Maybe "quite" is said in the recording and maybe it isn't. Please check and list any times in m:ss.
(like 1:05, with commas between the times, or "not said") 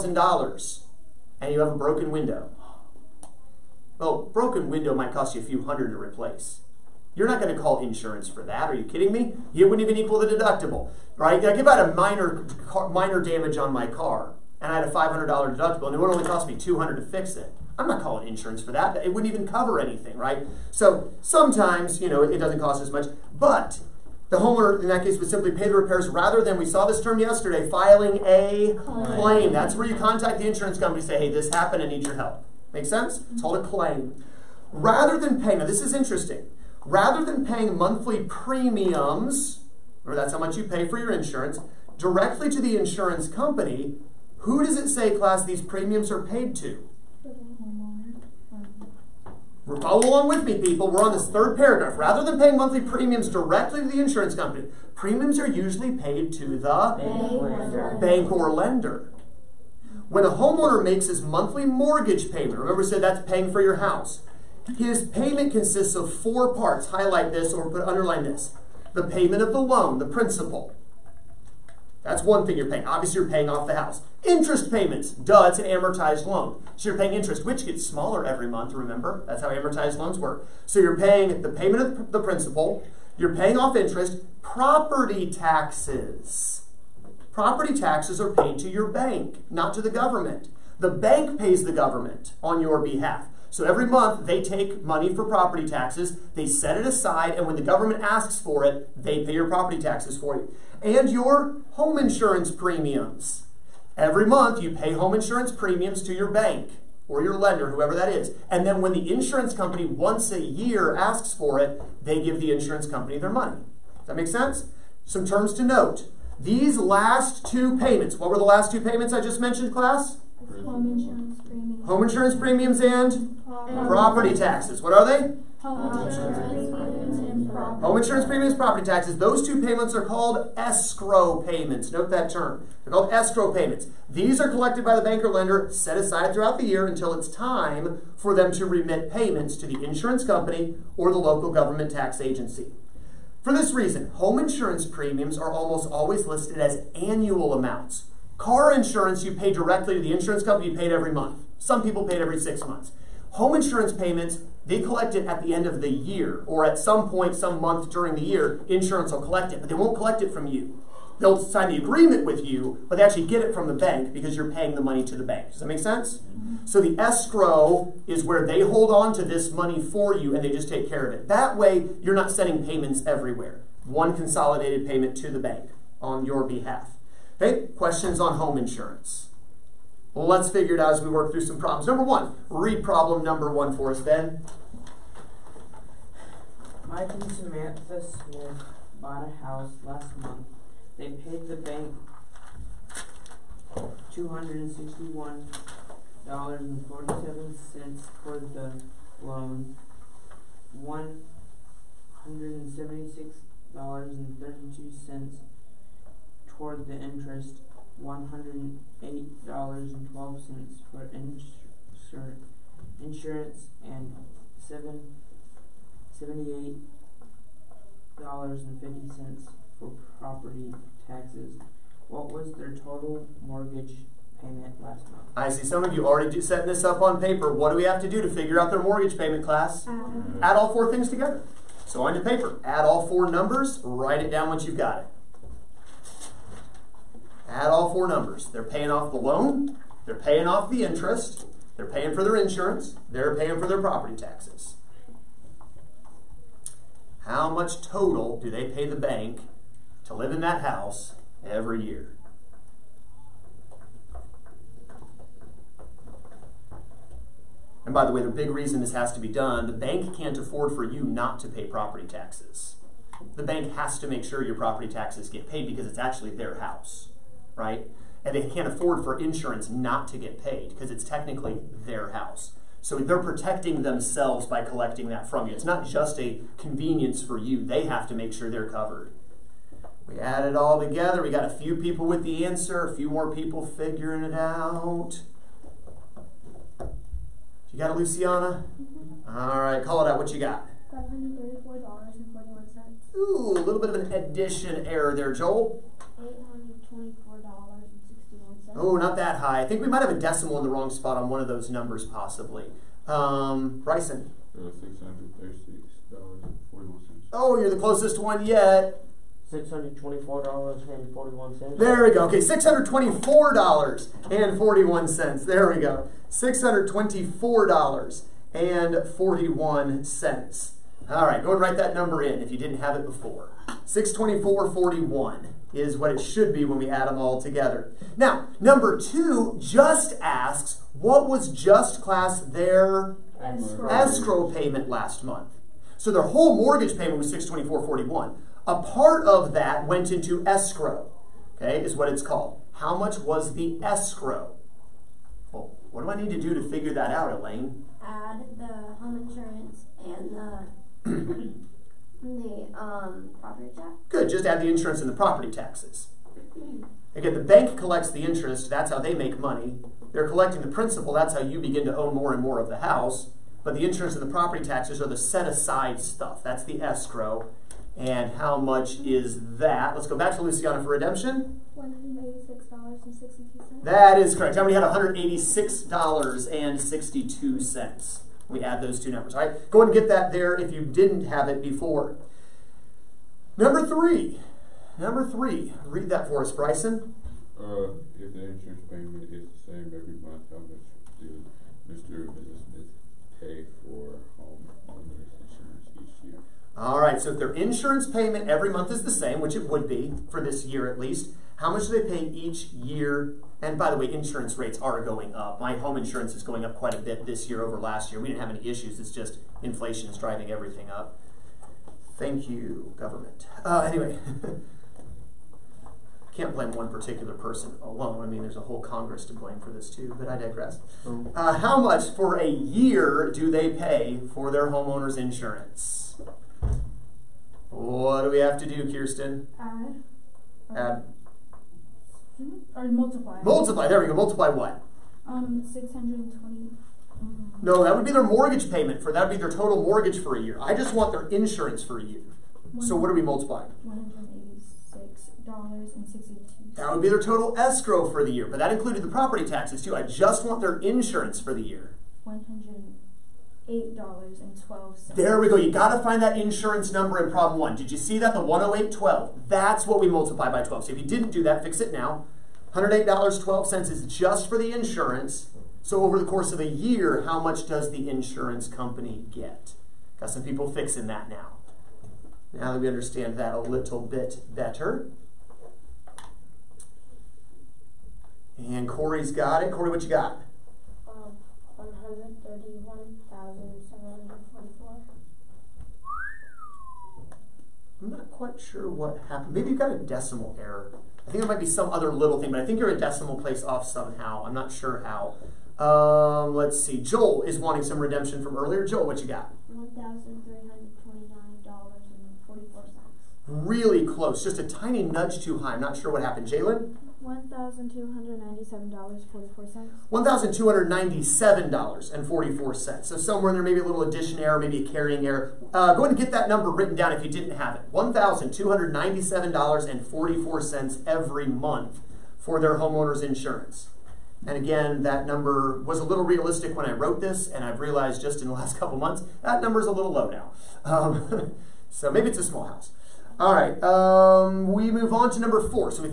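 6:46, 8:08.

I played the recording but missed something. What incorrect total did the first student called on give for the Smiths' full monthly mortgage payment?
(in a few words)
$534.41.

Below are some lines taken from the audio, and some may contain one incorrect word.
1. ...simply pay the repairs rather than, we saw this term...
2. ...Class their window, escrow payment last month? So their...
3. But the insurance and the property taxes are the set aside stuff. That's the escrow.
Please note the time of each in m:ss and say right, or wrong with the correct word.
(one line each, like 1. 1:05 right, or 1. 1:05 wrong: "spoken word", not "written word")
1. 0:25 right
2. 5:32 wrong: "escrow", not "window"
3. 6:03 right.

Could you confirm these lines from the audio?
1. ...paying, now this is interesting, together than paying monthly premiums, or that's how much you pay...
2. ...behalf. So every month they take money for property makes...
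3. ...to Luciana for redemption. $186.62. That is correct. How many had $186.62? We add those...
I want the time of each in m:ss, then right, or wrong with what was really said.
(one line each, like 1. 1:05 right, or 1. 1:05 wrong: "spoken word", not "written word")
1. 0:35 wrong: "rather", not "together"
2. 1:32 wrong: "taxes", not "makes"
3. 6:10 right.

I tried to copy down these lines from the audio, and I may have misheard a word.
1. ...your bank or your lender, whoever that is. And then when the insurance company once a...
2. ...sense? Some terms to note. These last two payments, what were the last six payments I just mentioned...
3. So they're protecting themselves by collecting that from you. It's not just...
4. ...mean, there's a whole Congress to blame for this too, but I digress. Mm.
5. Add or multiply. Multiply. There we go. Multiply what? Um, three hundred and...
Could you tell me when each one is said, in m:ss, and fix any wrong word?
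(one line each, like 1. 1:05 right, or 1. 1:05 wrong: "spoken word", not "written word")
1. 1:46 right
2. 1:54 wrong: "two", not "six"
3. 4:32 right
4. 6:58 right
5. 7:10 wrong: "six", not "three".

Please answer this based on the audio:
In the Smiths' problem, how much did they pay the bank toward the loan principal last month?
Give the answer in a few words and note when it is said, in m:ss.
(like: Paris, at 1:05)
$261.47, at 3:14.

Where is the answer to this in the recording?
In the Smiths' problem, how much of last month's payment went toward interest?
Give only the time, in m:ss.
3:20.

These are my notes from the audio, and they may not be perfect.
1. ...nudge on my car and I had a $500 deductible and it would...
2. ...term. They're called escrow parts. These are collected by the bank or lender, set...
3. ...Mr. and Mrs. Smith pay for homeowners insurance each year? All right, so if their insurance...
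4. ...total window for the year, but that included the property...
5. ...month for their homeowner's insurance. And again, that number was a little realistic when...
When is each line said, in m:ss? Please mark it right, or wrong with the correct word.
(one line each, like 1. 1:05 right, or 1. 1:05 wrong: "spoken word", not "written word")
1. 0:13 wrong: "damage", not "nudge"
2. 2:12 wrong: "payments", not "parts"
3. 6:31 right
4. 7:27 wrong: "escrow", not "window"
5. 8:41 right.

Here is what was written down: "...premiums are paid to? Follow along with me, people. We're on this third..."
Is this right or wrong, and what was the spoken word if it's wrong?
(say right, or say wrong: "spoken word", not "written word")
right.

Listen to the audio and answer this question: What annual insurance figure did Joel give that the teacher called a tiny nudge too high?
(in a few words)
$1,329.44.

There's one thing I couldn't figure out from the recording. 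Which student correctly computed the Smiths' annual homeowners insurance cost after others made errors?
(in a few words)
Jalen.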